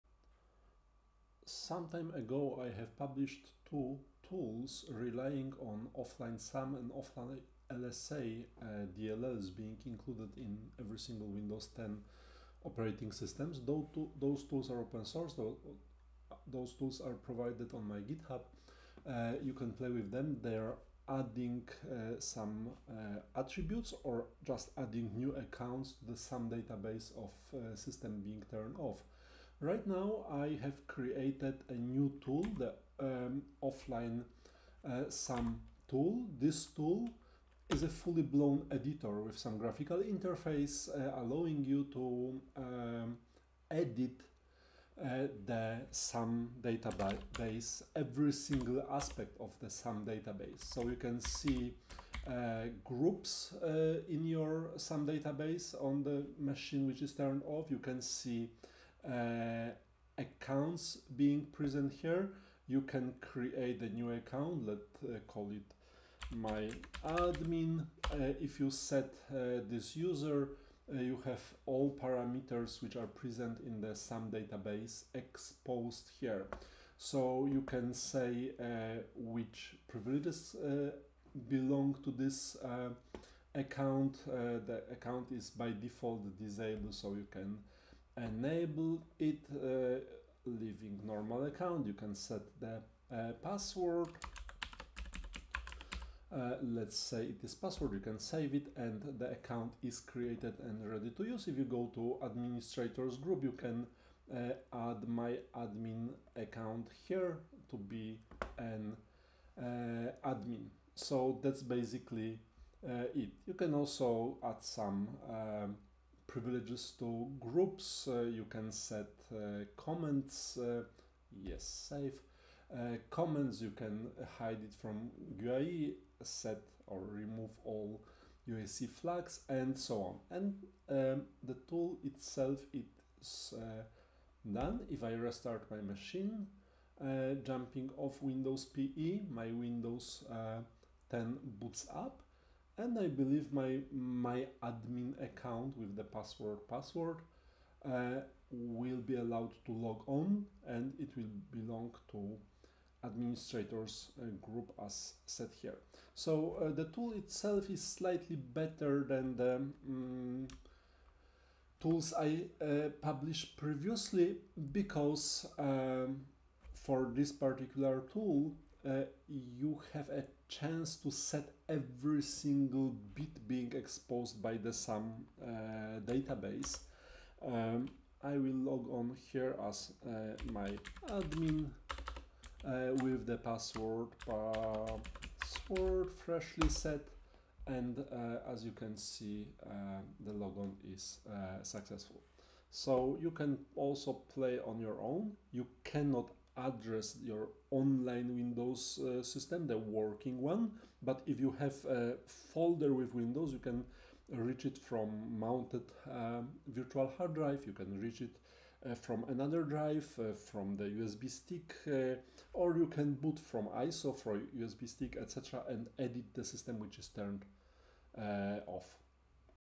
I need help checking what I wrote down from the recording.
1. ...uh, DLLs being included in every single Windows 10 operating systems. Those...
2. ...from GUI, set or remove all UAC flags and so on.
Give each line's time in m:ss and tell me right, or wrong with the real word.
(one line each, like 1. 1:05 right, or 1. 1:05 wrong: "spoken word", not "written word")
1. 0:08 right
2. 2:04 right.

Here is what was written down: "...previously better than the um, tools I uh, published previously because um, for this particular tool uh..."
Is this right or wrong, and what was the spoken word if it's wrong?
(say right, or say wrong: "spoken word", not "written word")
wrong: "slightly", not "previously".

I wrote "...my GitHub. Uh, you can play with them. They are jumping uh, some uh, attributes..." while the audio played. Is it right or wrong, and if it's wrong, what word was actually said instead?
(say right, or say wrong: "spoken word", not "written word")
wrong: "adding", not "jumping".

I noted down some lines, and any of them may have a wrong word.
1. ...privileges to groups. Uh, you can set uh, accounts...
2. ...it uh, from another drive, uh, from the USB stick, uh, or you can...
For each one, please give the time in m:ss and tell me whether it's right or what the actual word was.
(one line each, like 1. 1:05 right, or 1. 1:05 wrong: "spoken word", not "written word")
1. 1:56 wrong: "comments", not "accounts"
2. 3:28 right.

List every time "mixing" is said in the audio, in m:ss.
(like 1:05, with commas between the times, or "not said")
not said.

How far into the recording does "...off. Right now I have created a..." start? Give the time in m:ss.
0:28.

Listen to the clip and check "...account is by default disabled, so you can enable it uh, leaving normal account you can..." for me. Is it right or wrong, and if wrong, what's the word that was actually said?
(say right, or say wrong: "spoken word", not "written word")
right.